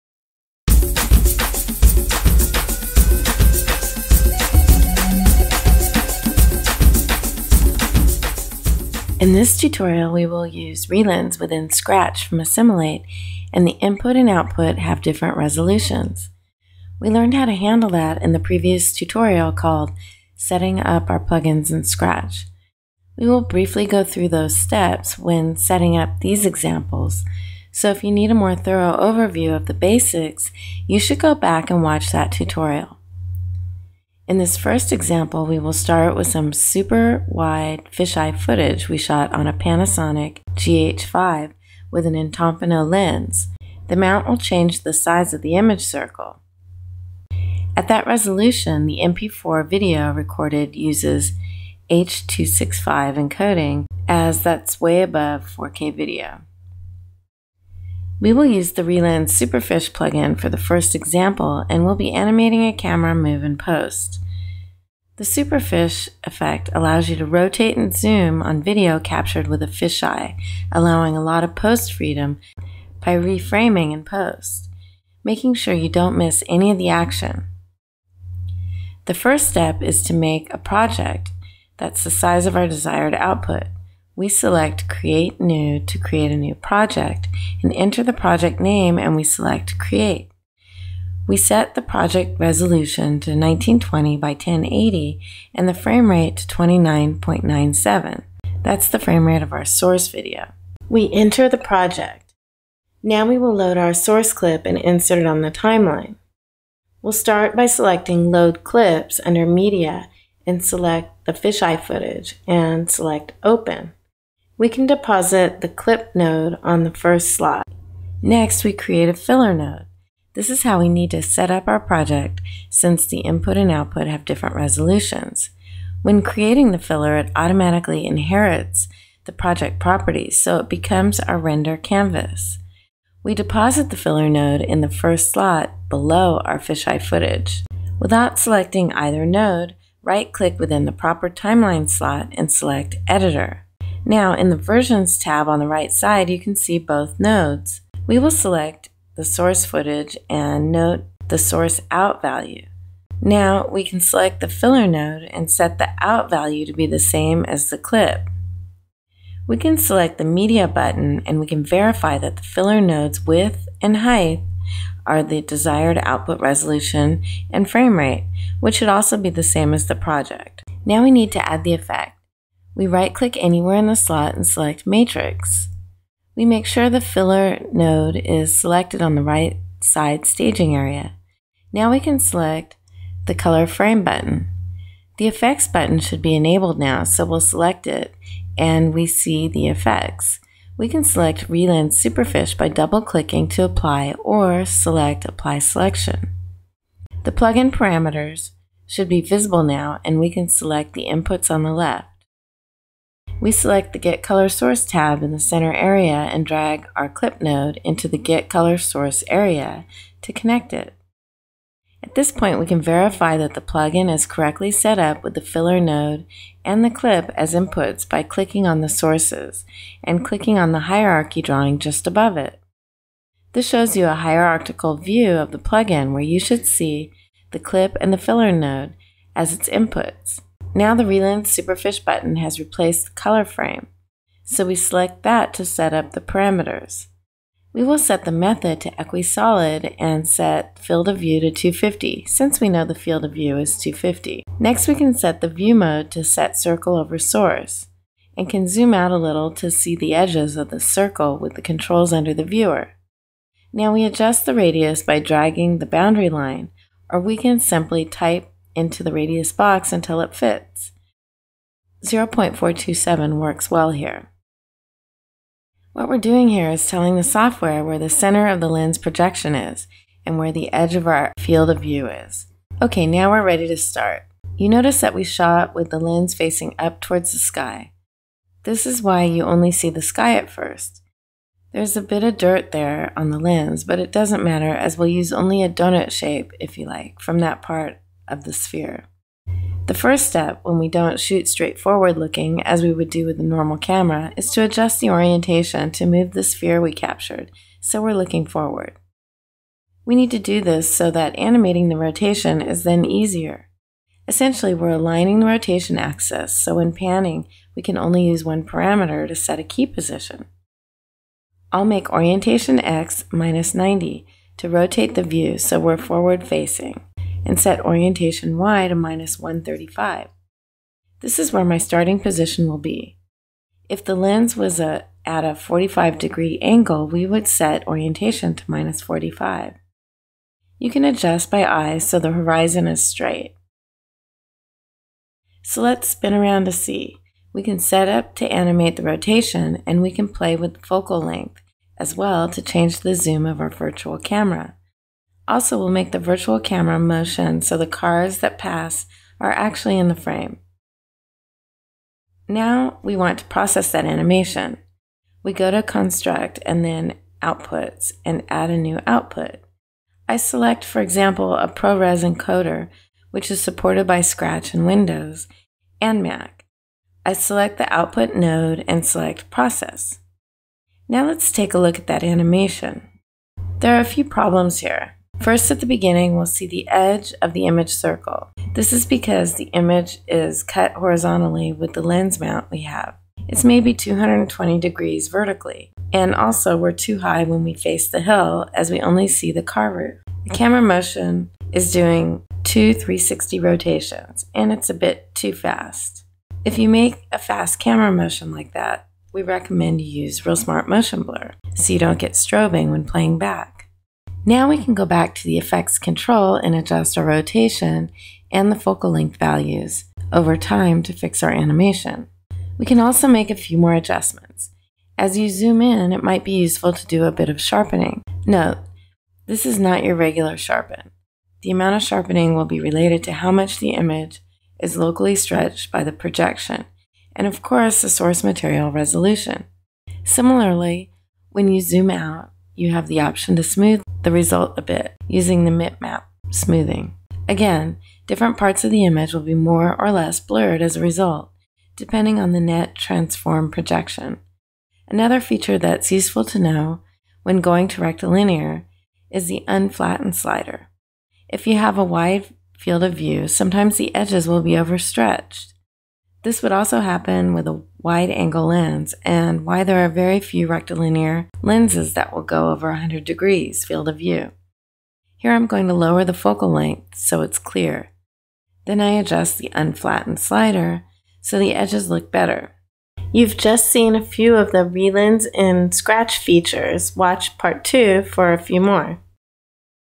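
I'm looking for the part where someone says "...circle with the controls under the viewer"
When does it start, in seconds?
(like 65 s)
250 s.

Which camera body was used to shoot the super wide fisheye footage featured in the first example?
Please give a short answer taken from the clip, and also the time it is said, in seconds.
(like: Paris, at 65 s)
Panasonic GH5, at 39 s.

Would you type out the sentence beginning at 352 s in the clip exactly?
Now we want to process that animation.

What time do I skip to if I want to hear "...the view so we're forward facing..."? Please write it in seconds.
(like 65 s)
315 s.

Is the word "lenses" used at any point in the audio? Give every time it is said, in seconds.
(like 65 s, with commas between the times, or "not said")
461 s.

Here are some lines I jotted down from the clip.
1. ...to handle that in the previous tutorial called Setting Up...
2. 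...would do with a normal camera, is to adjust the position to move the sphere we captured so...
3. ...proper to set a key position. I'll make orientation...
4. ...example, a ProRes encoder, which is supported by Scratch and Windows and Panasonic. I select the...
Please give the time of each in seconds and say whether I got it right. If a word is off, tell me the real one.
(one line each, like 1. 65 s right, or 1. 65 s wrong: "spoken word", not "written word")
1. 17 s right
2. 292 s wrong: "orientation", not "position"
3. 308 s wrong: "parameter", not "proper"
4. 361 s wrong: "Mac", not "Panasonic".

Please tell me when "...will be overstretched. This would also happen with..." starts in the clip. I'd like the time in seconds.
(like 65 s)
454 s.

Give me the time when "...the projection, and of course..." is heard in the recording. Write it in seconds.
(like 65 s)
426 s.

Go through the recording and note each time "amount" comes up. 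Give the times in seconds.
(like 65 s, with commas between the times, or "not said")
421 s.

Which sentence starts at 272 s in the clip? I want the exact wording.
Okay, now we're ready to start.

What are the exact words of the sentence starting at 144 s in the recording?
Now in the Versions tab on the right side, you can see both nodes.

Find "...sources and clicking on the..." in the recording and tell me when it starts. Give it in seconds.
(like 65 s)
218 s.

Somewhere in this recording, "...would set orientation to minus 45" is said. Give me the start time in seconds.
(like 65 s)
327 s.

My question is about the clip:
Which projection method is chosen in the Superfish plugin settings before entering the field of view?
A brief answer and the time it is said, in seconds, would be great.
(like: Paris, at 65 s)
Equisolid, at 238 s.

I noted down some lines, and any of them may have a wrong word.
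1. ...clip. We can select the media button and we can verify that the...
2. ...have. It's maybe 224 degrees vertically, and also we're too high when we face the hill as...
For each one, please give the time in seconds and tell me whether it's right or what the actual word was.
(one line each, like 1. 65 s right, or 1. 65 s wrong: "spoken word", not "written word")
1. 157 s right
2. 382 s wrong: "220", not "224".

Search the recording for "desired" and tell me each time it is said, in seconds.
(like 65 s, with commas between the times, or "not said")
82 s, 165 s.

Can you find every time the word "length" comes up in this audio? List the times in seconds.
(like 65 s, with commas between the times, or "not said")
341 s, 409 s, 466 s.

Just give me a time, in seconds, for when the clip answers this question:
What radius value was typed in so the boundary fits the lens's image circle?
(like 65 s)
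262 s.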